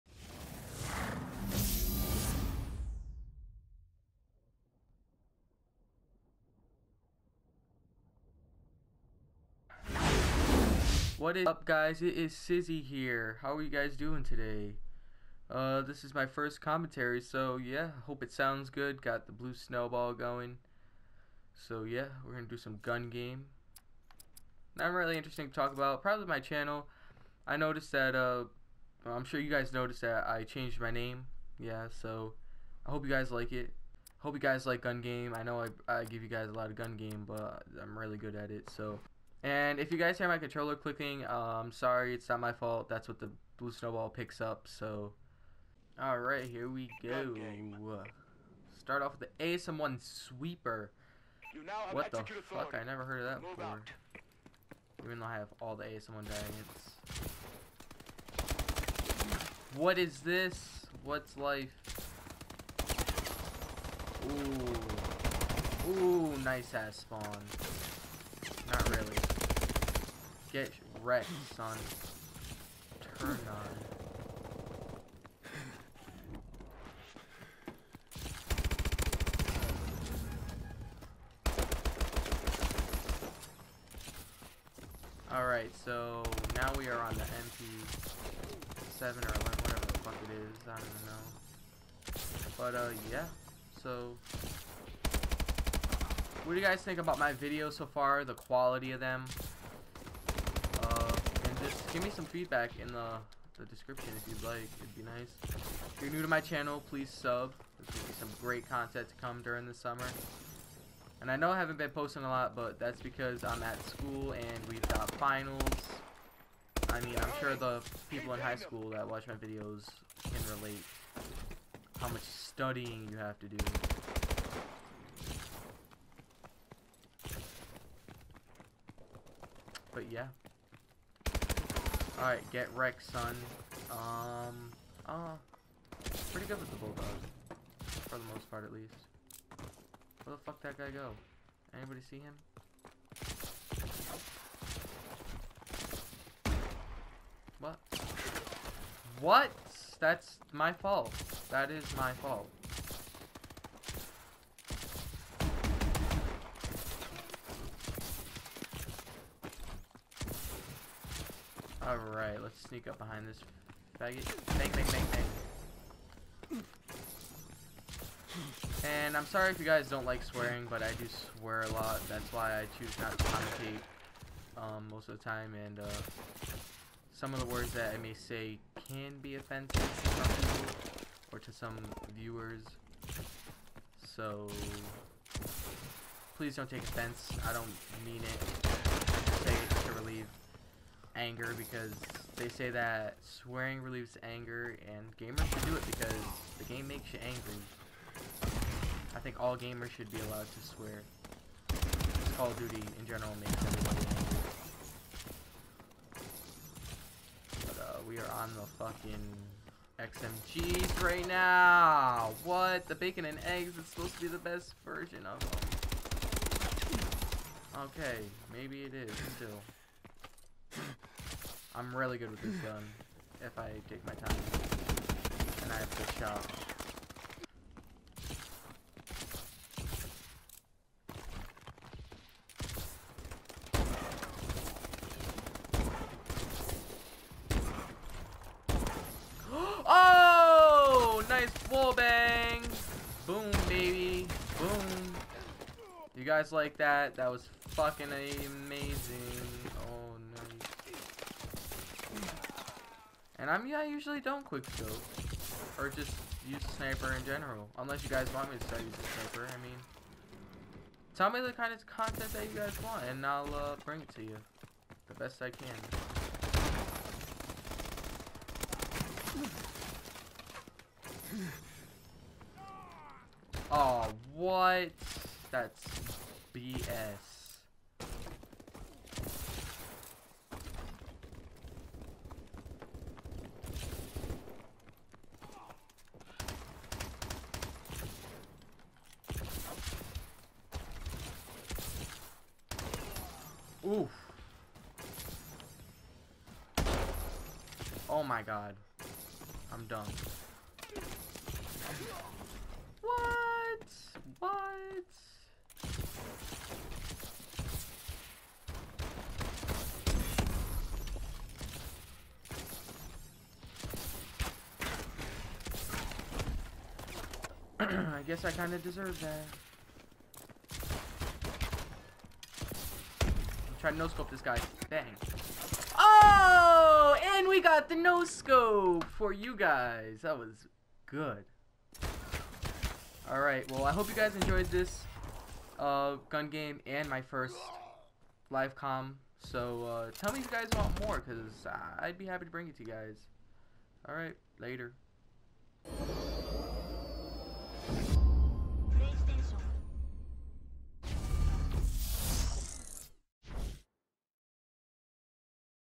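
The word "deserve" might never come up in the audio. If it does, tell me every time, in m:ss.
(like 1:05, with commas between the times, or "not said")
5:18.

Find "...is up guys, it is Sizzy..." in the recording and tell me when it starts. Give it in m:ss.
0:11.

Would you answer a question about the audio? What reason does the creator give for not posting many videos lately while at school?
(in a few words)
finals.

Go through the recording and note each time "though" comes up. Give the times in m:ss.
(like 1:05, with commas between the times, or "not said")
0:55.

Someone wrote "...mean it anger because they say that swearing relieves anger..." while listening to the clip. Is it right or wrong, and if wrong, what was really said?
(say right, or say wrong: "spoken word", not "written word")
right.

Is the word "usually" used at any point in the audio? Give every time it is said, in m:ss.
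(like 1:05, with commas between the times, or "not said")
4:13.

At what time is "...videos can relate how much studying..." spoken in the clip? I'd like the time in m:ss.
1:59.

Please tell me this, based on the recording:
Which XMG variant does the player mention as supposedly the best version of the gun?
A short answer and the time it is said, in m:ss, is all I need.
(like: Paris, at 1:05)
bacon and eggs, at 3:32.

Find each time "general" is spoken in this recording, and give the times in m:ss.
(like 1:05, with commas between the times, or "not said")
3:23, 4:17.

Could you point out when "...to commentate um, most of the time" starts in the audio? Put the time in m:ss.
2:53.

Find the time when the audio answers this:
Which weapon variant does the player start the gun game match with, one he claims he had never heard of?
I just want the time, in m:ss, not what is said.
0:49.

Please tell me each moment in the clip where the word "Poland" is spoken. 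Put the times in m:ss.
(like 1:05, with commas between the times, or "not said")
not said.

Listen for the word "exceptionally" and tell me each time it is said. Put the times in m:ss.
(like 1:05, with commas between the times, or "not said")
not said.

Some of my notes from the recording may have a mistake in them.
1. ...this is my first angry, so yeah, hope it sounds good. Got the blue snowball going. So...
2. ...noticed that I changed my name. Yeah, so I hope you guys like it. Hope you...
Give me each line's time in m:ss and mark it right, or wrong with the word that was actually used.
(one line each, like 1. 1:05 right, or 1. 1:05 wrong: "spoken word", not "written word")
1. 0:15 wrong: "commentary", not "angry"
2. 0:29 right.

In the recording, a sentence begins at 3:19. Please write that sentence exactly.
I think all gamers should be allowed to swear.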